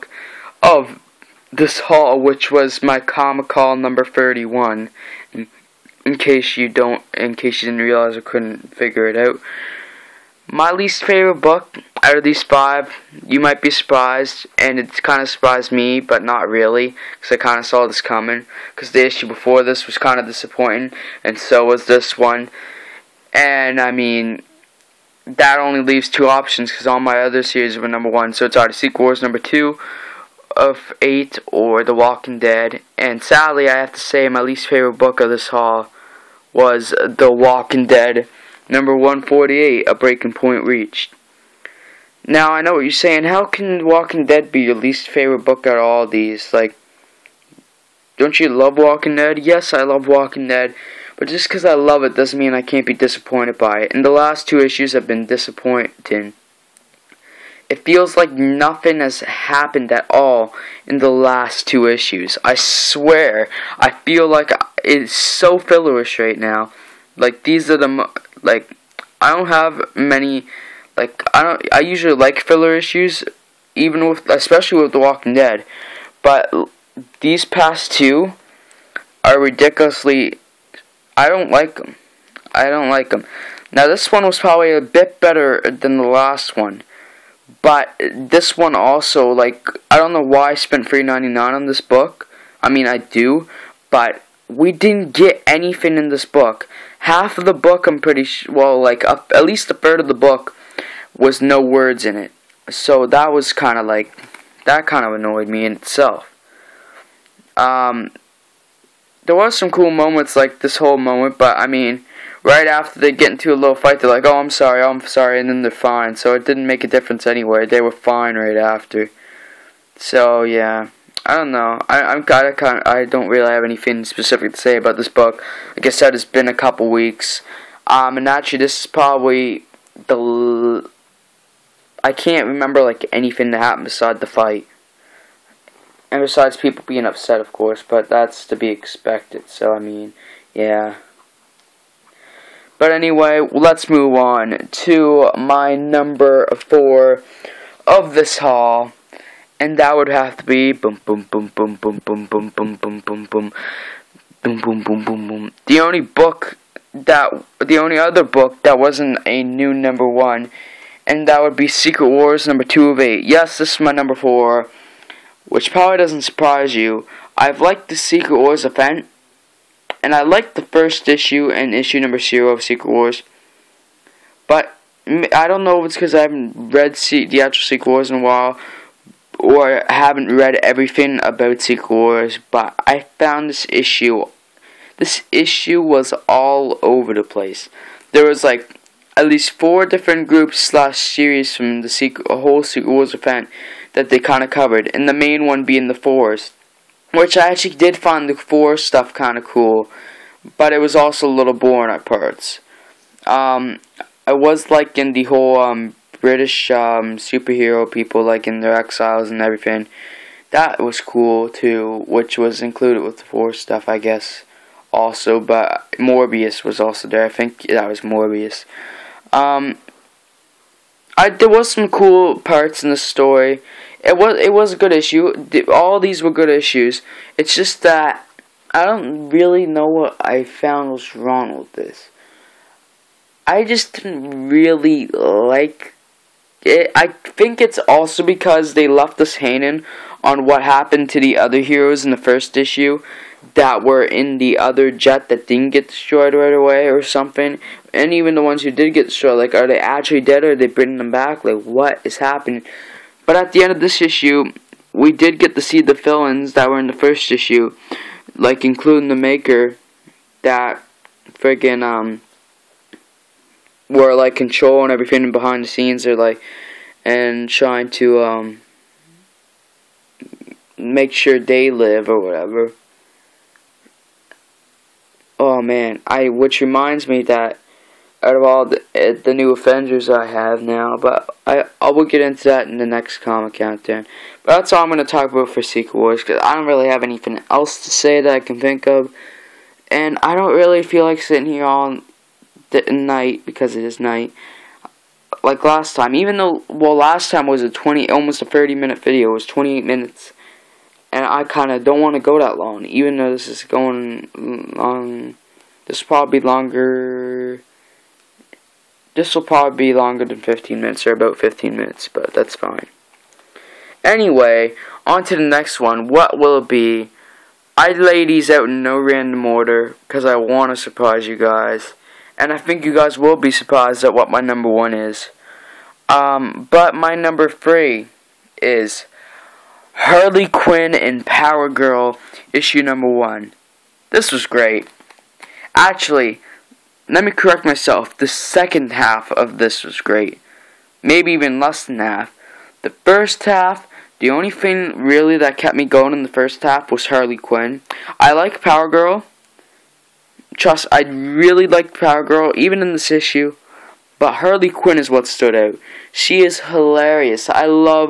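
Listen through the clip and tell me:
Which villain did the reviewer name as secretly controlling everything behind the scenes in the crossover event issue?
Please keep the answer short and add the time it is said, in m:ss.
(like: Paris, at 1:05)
The Maker, at 4:19.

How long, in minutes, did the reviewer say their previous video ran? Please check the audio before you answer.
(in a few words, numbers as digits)
28 minutes.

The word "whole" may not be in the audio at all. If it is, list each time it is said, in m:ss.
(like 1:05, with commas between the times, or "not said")
1:50, 3:12, 3:25.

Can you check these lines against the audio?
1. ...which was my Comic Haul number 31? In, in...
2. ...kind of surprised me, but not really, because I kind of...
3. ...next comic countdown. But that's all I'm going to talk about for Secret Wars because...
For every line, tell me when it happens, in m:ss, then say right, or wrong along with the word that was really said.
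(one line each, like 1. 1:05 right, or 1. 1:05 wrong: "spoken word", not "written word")
1. 0:02 right
2. 0:15 right
3. 4:42 right.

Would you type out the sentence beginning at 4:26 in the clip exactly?
or like and trying to um, make sure they live or whatever.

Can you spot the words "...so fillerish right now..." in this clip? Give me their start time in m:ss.
1:05.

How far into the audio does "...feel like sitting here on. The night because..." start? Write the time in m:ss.
4:50.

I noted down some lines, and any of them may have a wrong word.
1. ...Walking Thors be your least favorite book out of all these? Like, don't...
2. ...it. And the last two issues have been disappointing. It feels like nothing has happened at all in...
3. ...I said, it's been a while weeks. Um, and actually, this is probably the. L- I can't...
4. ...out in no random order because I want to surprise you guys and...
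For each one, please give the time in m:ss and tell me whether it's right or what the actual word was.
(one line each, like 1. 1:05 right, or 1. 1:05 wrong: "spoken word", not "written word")
1. 0:43 wrong: "Dead", not "Thors"
2. 0:53 right
3. 2:05 wrong: "couple", not "while"
4. 5:18 right.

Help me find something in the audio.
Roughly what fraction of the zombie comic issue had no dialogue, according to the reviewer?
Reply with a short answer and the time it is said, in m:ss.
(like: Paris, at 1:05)
A third, at 1:39.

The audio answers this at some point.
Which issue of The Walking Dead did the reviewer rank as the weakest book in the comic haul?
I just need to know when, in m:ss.
0:38.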